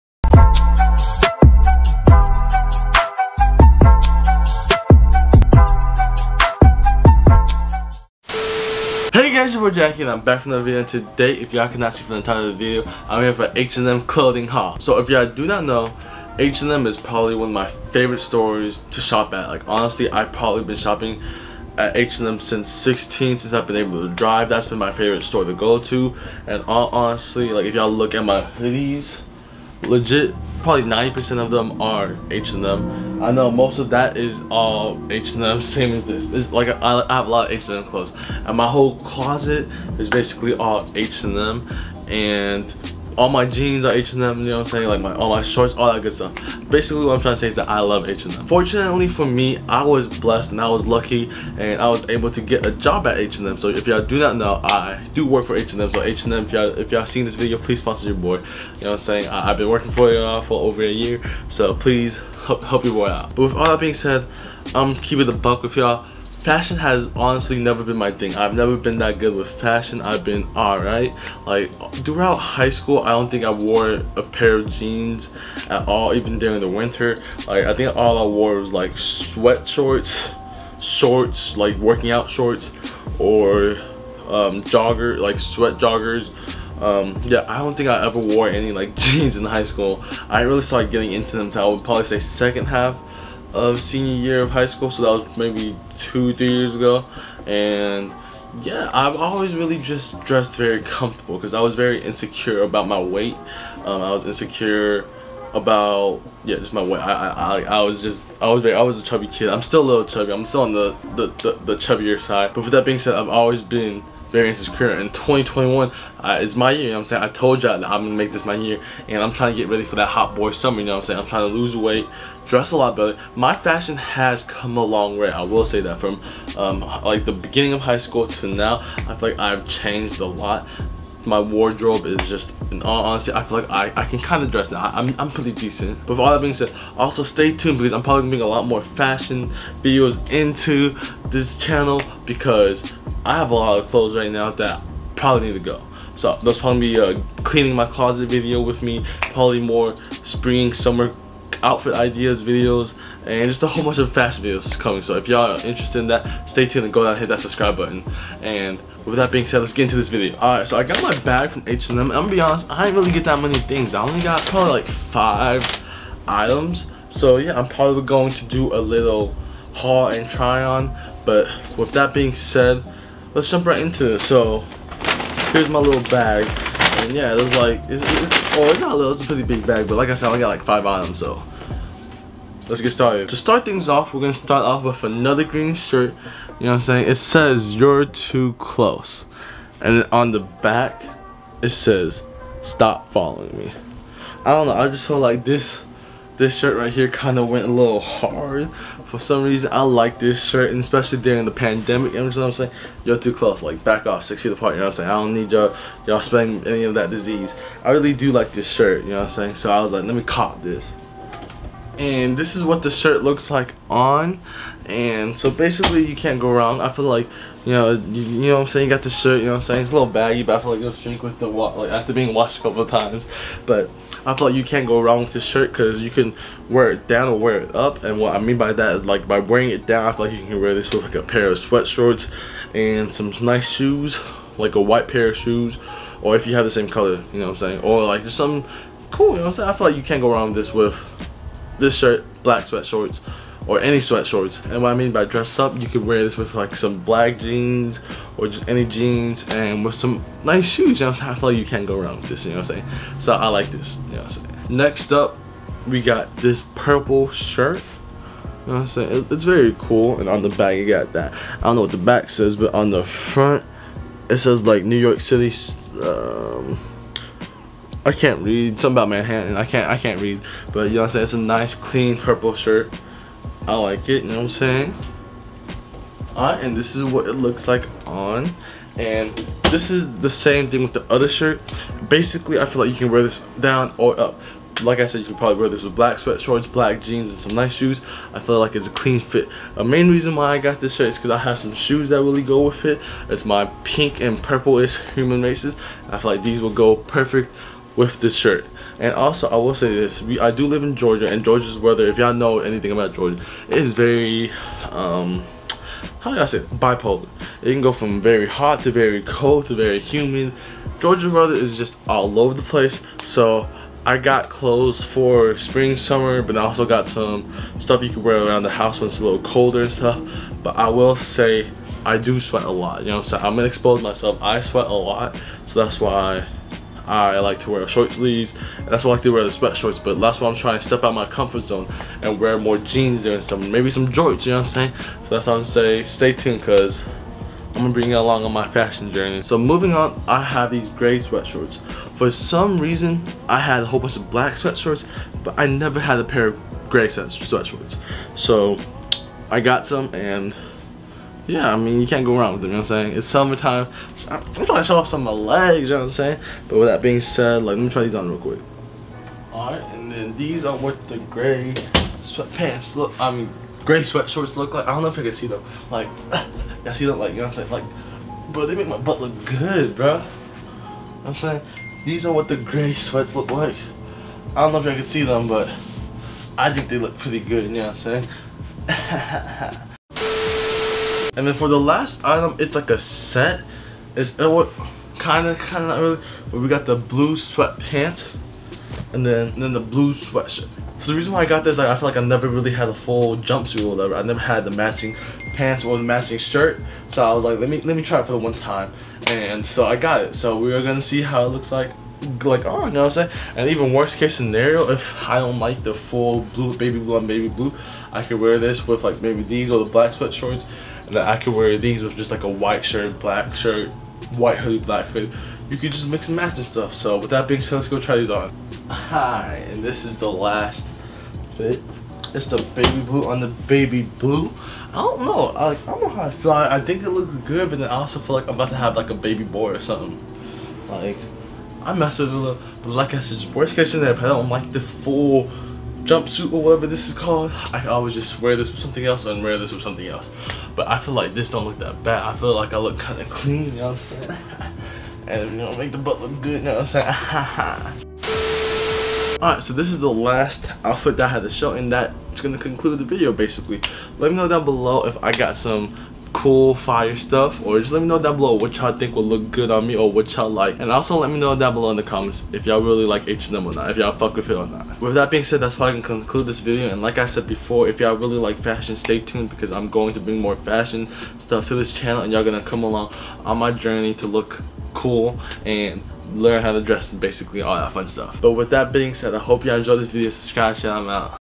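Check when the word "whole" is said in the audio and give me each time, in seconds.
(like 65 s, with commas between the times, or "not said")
38 s, 153 s, 343 s.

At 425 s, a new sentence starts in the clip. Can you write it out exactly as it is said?
I, I don't know how I feel.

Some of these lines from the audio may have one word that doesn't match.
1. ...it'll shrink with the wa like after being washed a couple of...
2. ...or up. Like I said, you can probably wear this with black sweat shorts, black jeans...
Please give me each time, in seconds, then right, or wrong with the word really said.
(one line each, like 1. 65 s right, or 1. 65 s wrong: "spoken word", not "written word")
1. 220 s right
2. 283 s right.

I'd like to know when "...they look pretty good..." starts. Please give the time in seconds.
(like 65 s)
376 s.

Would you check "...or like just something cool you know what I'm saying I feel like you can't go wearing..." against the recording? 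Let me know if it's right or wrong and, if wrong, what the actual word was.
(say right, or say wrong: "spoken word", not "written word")
wrong: "wrong", not "wearing".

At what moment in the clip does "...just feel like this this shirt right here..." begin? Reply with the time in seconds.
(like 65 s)
194 s.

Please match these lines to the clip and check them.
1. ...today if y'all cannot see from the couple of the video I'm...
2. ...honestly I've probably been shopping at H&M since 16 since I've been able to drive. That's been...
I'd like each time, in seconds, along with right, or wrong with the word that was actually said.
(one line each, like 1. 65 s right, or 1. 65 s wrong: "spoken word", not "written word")
1. 10 s wrong: "title", not "couple"
2. 19 s right.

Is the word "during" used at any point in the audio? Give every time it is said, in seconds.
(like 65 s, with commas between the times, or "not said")
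76 s, 201 s.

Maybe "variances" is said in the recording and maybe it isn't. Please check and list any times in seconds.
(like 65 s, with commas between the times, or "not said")
114 s.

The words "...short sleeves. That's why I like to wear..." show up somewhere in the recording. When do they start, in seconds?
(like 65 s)
327 s.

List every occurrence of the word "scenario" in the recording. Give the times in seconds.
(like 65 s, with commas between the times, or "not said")
404 s, 433 s.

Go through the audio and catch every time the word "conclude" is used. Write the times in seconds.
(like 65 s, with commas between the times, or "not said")
452 s, 466 s.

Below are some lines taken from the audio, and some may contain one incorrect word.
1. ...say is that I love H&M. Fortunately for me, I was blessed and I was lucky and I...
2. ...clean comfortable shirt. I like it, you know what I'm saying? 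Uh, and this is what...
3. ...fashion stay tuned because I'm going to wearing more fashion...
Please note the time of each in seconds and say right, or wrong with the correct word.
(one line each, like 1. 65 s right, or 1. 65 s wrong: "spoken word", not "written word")
1. 47 s right
2. 271 s wrong: "purple", not "comfortable"
3. 468 s wrong: "bring", not "wearing".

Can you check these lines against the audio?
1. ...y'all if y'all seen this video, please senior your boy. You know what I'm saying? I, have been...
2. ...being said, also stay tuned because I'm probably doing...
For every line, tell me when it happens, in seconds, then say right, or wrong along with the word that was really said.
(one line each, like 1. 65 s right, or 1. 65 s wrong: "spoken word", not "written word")
1. 56 s wrong: "sponsor", not "senior"
2. 136 s right.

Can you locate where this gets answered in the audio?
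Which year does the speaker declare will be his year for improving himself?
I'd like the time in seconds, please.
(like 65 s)
115 s.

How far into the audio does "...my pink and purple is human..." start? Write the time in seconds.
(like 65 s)
293 s.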